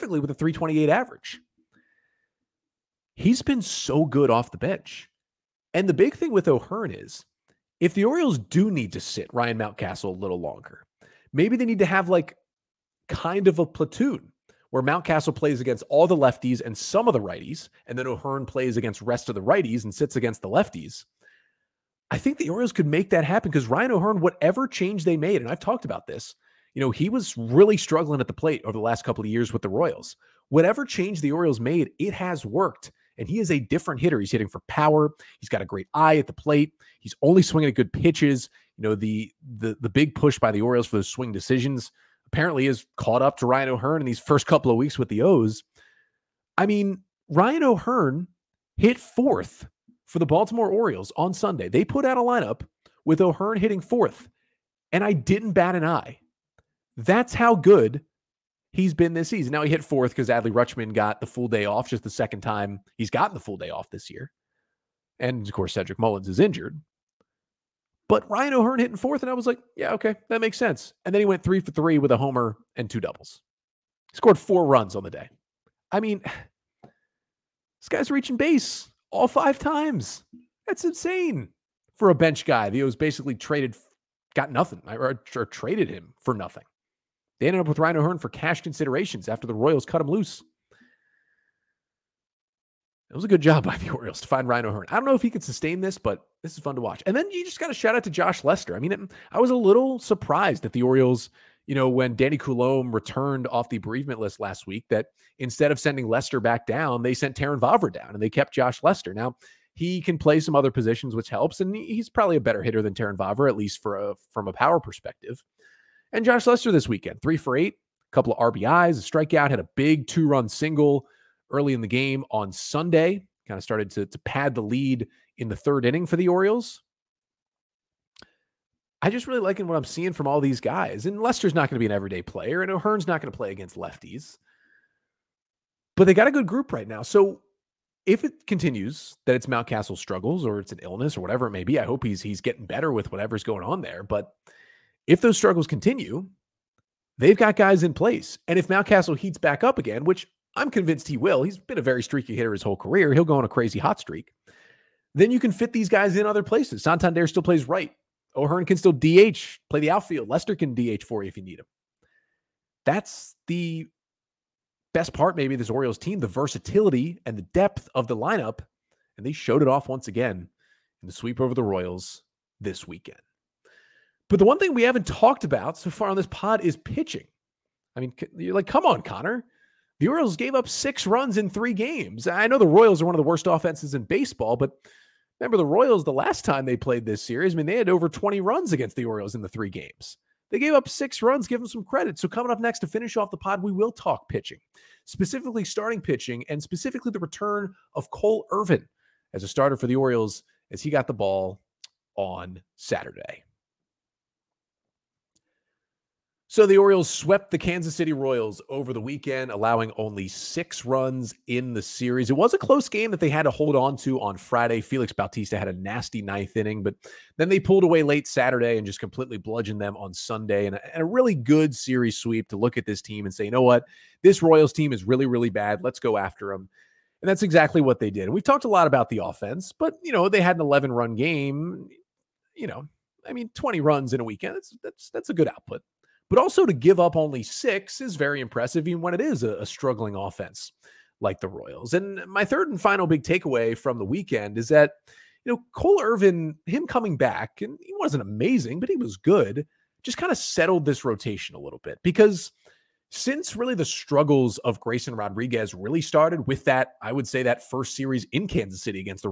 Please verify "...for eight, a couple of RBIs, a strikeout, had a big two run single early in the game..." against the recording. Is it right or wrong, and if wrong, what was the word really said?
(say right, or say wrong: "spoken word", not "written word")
right.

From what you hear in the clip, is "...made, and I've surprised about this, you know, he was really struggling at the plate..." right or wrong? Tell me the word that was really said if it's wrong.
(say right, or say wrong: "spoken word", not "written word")
wrong: "talked", not "surprised".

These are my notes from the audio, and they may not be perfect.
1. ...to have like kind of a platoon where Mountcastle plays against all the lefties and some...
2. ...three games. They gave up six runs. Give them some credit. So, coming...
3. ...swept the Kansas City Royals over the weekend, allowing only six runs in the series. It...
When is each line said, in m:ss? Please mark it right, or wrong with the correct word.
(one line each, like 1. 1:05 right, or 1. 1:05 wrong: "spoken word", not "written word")
1. 0:11 right
2. 3:09 right
3. 3:27 right.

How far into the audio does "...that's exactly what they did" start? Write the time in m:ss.
3:47.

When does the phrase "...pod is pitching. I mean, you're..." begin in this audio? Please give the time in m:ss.
2:56.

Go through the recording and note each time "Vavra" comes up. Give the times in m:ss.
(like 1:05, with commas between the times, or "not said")
1:47, 1:53.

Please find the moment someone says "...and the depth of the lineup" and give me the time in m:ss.
2:47.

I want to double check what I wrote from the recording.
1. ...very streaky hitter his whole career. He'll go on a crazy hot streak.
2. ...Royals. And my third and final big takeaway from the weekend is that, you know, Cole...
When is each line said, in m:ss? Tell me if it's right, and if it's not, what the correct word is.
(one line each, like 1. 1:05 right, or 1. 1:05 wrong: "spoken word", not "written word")
1. 2:31 right
2. 4:01 right.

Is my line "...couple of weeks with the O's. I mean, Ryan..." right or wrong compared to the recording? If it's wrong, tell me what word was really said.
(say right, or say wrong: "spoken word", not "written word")
right.